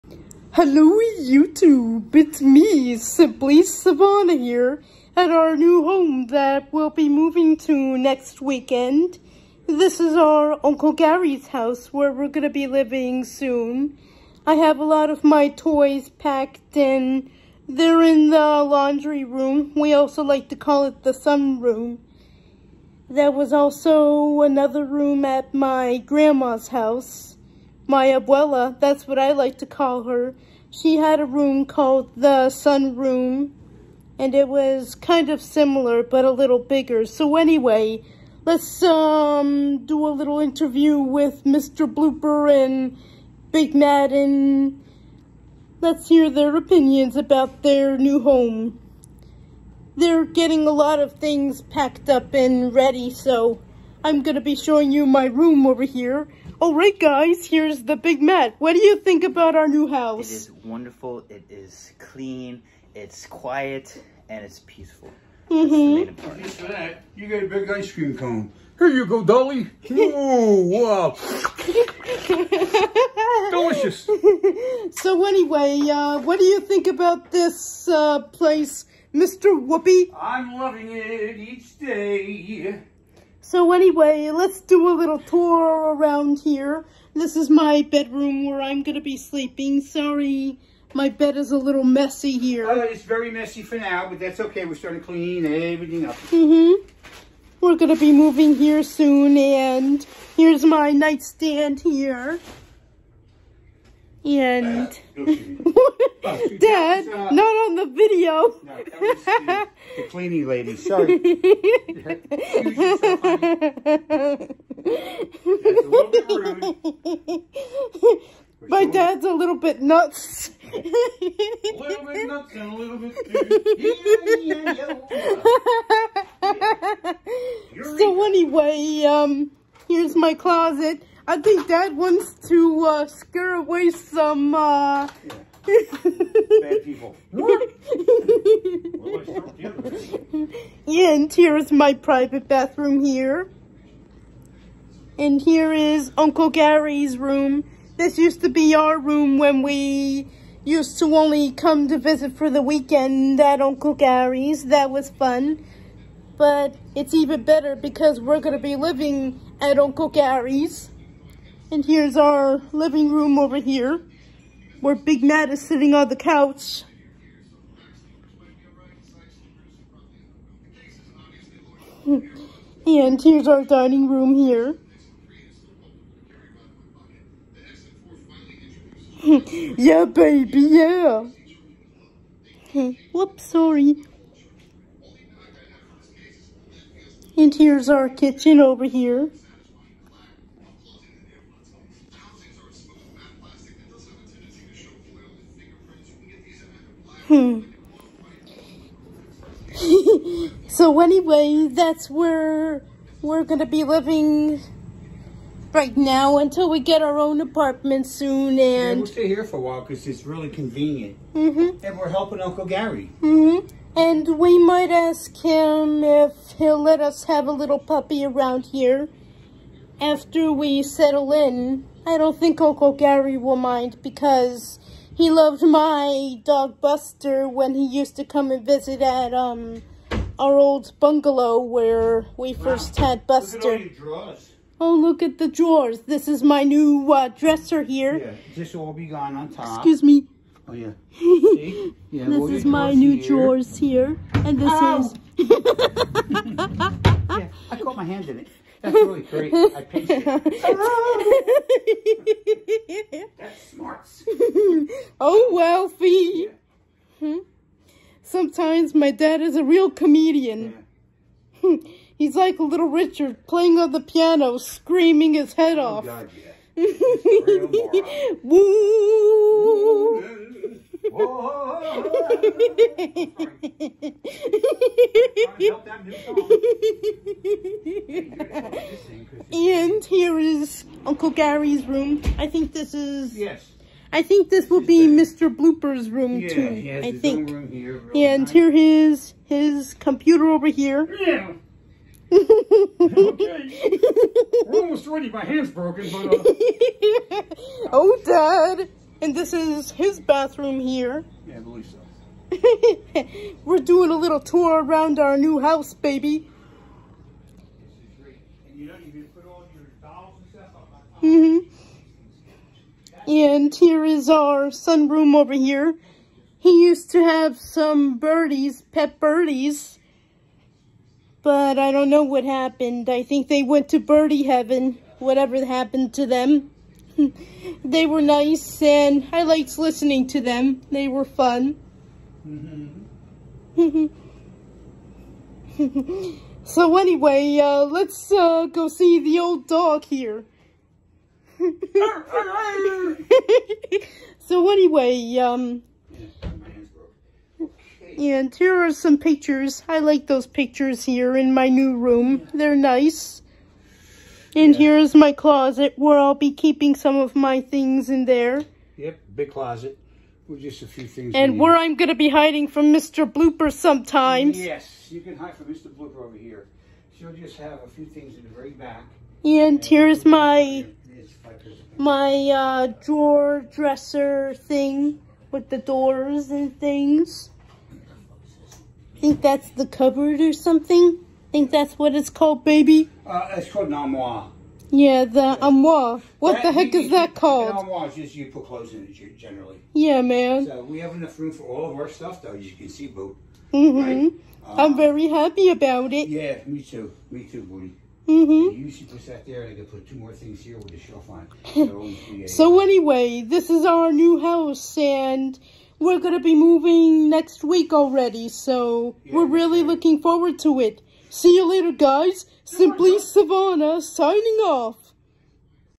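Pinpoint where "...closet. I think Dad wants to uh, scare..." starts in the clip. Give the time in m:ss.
2:10.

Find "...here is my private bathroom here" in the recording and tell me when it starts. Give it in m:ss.
2:21.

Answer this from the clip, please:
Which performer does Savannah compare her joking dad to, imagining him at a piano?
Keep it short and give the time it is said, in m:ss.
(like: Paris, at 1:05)
Little Richard, at 4:22.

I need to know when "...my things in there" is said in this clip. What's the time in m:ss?
5:57.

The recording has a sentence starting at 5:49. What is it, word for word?
I like those pictures here in my new room.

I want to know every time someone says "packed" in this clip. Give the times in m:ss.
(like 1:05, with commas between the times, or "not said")
0:16, 0:51.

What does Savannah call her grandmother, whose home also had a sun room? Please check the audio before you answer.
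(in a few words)
abuela.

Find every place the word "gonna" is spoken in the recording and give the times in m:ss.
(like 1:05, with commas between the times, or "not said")
0:54, 3:23.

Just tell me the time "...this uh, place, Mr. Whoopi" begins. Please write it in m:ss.
1:17.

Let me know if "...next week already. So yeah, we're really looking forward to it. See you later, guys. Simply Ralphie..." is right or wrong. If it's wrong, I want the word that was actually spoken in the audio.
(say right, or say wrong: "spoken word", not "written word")
wrong: "Savannah", not "Ralphie".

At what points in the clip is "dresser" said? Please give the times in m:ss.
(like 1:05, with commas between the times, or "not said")
3:57, 6:13.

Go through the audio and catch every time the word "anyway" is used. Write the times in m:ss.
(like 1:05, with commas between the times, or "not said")
0:37, 1:15, 1:23, 2:08, 3:20, 5:36, 5:44, 6:42.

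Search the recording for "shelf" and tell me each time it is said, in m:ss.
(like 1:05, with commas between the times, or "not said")
6:40.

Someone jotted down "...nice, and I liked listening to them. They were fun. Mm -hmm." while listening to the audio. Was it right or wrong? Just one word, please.
right.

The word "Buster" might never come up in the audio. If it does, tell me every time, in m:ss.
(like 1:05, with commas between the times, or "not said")
3:46, 3:53.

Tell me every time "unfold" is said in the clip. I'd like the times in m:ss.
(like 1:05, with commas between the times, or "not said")
not said.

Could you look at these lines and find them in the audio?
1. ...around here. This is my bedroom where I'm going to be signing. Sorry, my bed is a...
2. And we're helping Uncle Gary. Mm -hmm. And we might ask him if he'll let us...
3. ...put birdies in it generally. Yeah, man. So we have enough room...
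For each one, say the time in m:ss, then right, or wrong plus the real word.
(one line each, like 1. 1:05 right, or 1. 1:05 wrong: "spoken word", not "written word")
1. 1:25 wrong: "sleeping", not "signing"
2. 3:31 right
3. 6:28 wrong: "clothes", not "birdies".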